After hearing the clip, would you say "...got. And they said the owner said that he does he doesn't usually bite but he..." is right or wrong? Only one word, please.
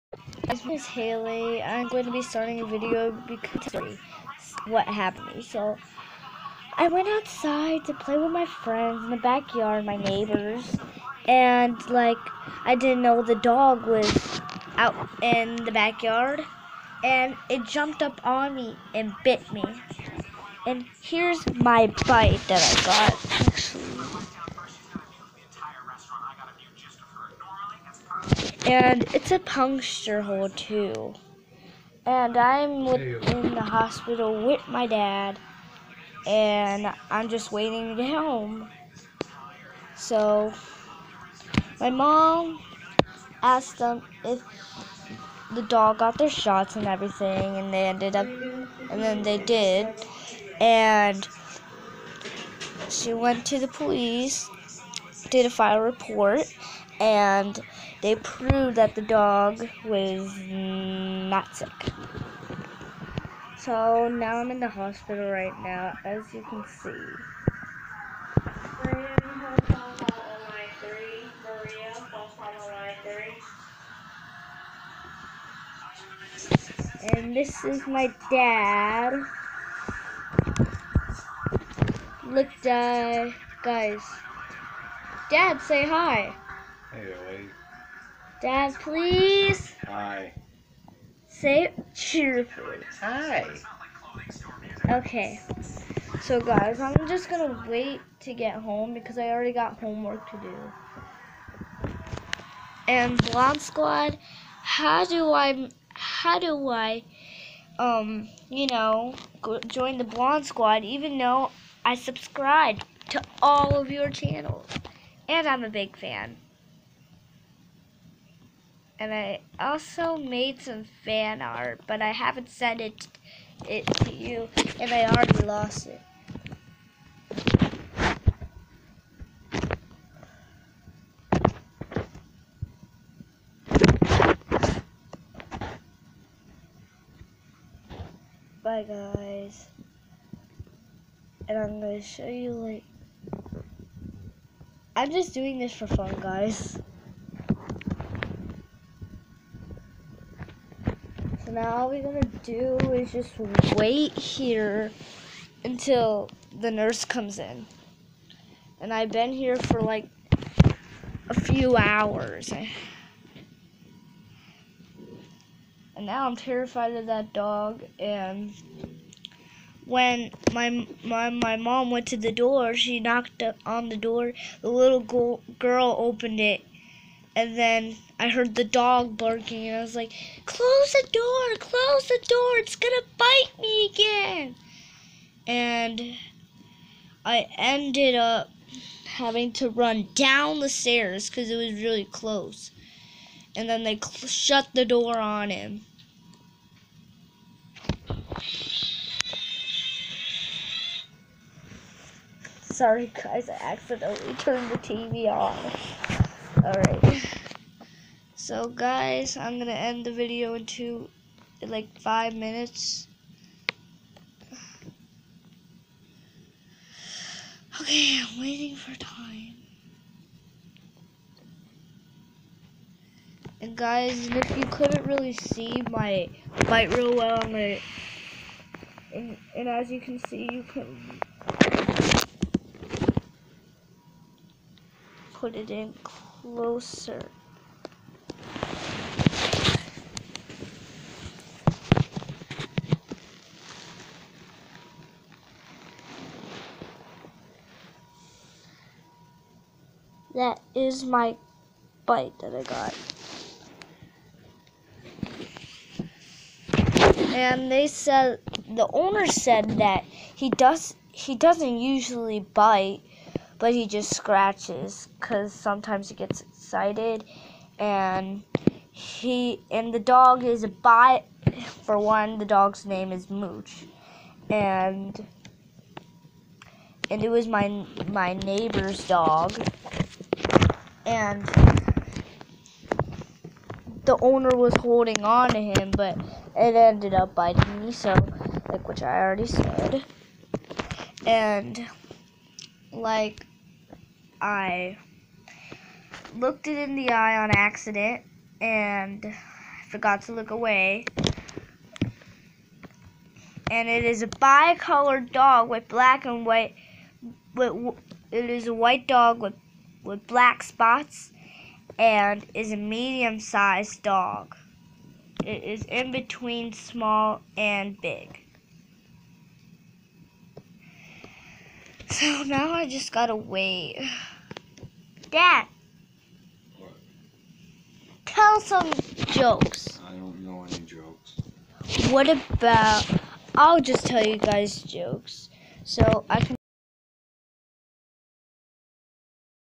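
right.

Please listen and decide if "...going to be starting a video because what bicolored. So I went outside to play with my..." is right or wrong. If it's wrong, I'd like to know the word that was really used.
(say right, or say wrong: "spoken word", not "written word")
wrong: "happened", not "bicolored".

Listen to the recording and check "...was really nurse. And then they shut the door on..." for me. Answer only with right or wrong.
wrong.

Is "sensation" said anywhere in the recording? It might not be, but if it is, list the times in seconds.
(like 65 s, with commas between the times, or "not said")
not said.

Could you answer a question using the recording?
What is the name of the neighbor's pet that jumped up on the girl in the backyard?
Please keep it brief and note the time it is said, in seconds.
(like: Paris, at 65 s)
Mooch, at 273 s.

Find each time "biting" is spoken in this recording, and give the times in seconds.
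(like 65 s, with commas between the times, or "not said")
287 s.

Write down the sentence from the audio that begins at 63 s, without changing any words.
So now I'm in the hospital right now, as you can see.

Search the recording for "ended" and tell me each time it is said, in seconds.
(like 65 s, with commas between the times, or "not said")
47 s, 187 s, 286 s.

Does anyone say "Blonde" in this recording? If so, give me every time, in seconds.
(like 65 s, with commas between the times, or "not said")
103 s, 110 s.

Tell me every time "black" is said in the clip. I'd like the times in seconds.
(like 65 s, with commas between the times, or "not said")
305 s, 310 s.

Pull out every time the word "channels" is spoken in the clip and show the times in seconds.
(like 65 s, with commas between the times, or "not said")
114 s.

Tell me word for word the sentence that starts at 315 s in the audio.
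It is in between small and big.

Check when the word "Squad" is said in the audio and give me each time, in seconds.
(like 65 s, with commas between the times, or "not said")
103 s, 110 s.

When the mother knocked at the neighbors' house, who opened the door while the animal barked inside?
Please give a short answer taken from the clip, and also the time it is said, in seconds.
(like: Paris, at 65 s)
the little girl, at 174 s.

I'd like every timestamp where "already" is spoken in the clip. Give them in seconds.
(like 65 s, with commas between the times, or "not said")
99 s, 125 s, 289 s.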